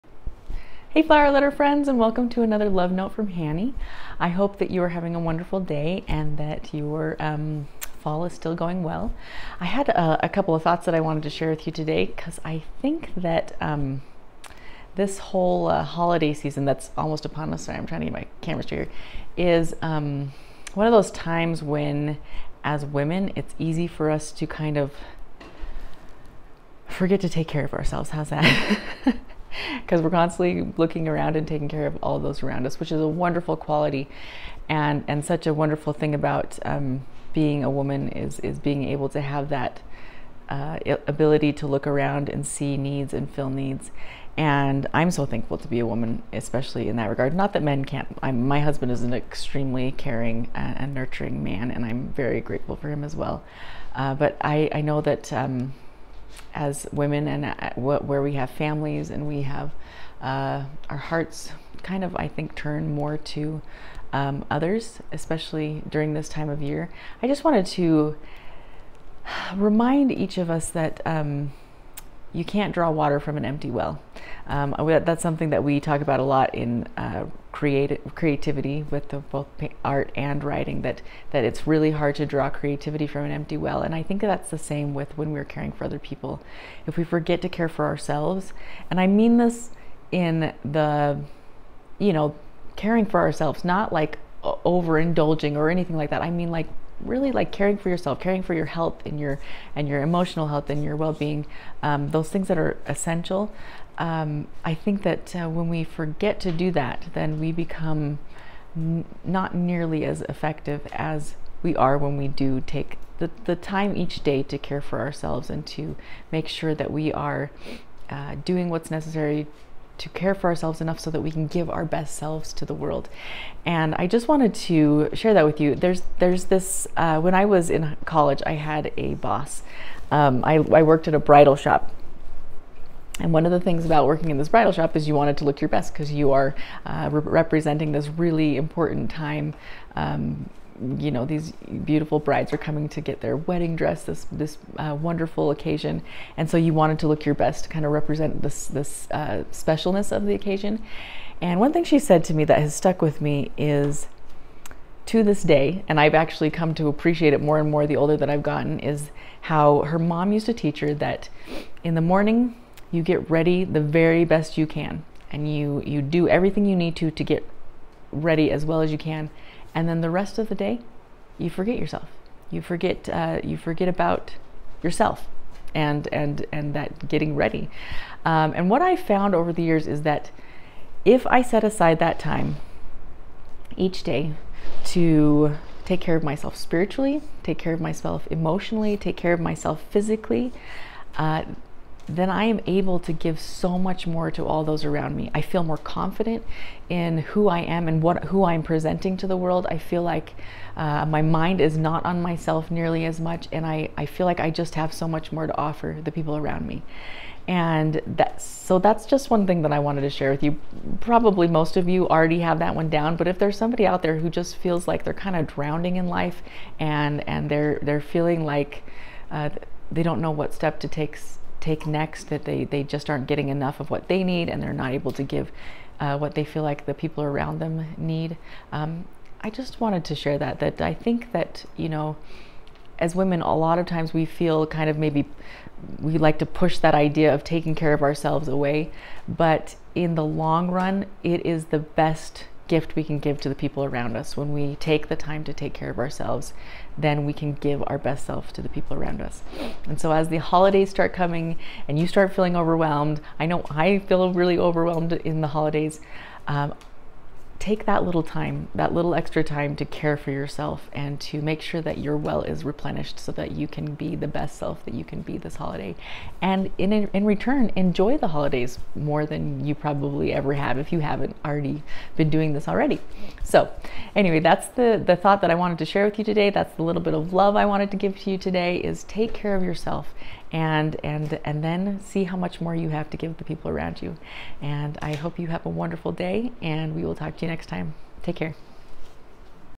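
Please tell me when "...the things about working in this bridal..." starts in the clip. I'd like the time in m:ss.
2:13.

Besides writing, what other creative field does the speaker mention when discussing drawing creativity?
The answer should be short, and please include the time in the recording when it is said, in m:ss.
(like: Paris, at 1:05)
Art, at 1:19.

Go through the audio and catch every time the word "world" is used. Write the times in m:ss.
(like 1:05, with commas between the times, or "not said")
2:02, 3:19.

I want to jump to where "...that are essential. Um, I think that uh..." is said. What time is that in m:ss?
1:42.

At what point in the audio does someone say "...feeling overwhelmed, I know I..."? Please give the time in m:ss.
4:12.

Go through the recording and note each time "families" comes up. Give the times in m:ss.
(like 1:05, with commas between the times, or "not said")
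0:58.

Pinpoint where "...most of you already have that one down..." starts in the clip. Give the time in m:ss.
3:31.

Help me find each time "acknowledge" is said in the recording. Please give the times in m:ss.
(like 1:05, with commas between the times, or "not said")
not said.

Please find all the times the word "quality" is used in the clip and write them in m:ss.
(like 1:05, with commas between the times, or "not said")
0:33.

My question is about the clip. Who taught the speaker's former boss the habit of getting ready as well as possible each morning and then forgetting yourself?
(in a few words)
Her mom.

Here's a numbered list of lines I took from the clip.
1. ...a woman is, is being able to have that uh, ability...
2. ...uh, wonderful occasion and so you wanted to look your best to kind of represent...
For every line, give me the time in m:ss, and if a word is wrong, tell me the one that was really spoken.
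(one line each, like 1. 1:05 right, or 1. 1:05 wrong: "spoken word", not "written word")
1. 0:37 right
2. 2:24 right.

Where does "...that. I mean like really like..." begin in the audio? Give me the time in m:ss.
1:36.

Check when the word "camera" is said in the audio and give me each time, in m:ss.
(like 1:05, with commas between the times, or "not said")
0:18.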